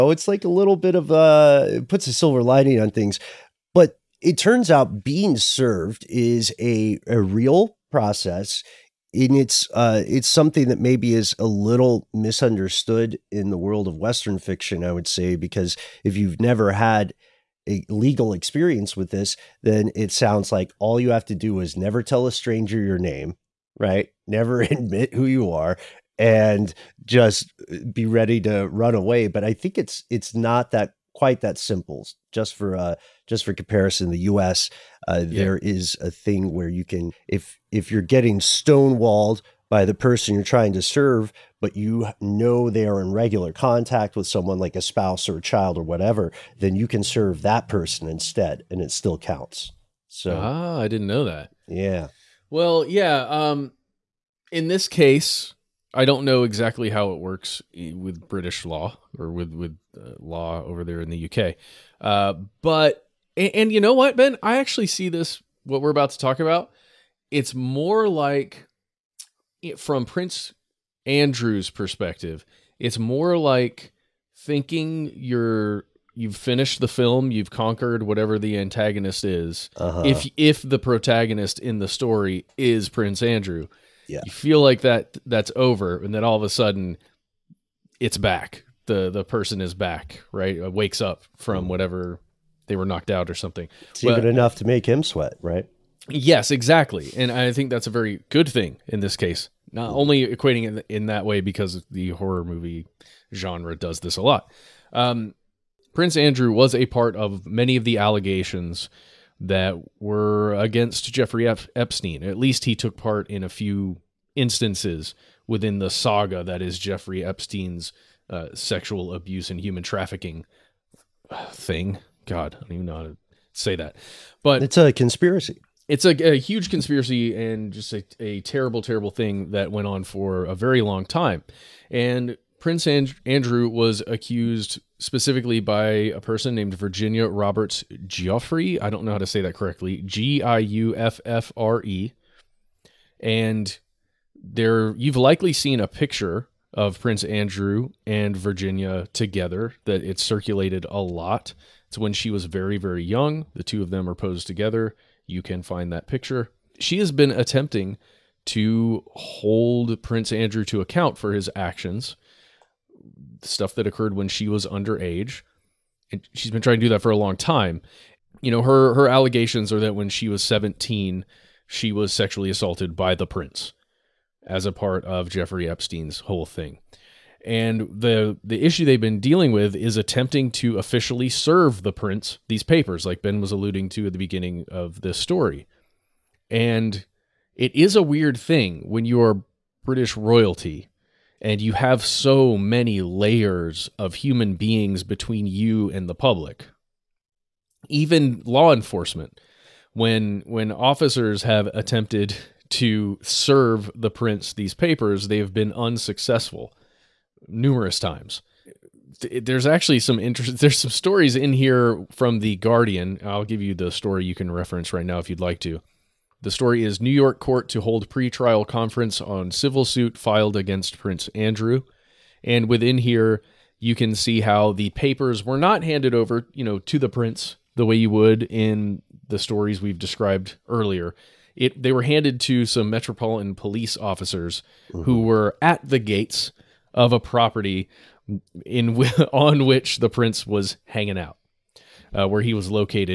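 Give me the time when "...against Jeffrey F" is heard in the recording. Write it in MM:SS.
01:50.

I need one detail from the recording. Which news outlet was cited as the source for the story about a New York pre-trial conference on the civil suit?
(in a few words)
The Guardian.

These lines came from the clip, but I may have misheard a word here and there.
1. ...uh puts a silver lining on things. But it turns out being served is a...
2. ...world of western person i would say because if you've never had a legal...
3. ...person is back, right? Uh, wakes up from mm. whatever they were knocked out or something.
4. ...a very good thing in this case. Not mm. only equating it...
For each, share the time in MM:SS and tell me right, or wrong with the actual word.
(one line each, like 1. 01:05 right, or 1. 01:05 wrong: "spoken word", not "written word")
1. 00:01 right
2. 00:13 wrong: "fiction", not "person"
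3. 01:29 right
4. 01:37 right.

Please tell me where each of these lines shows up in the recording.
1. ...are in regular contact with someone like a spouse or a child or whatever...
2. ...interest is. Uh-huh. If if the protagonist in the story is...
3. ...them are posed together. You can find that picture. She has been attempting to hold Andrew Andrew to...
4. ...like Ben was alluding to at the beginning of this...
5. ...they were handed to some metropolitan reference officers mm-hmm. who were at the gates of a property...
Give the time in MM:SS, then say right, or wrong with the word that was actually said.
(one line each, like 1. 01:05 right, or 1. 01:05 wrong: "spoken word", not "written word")
1. 00:42 right
2. 01:18 wrong: "antagonist", not "interest"
3. 02:33 wrong: "Prince", not "Andrew"
4. 03:03 right
5. 03:51 wrong: "police", not "reference".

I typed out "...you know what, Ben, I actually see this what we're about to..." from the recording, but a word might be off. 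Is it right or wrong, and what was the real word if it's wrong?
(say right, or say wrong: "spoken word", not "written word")
right.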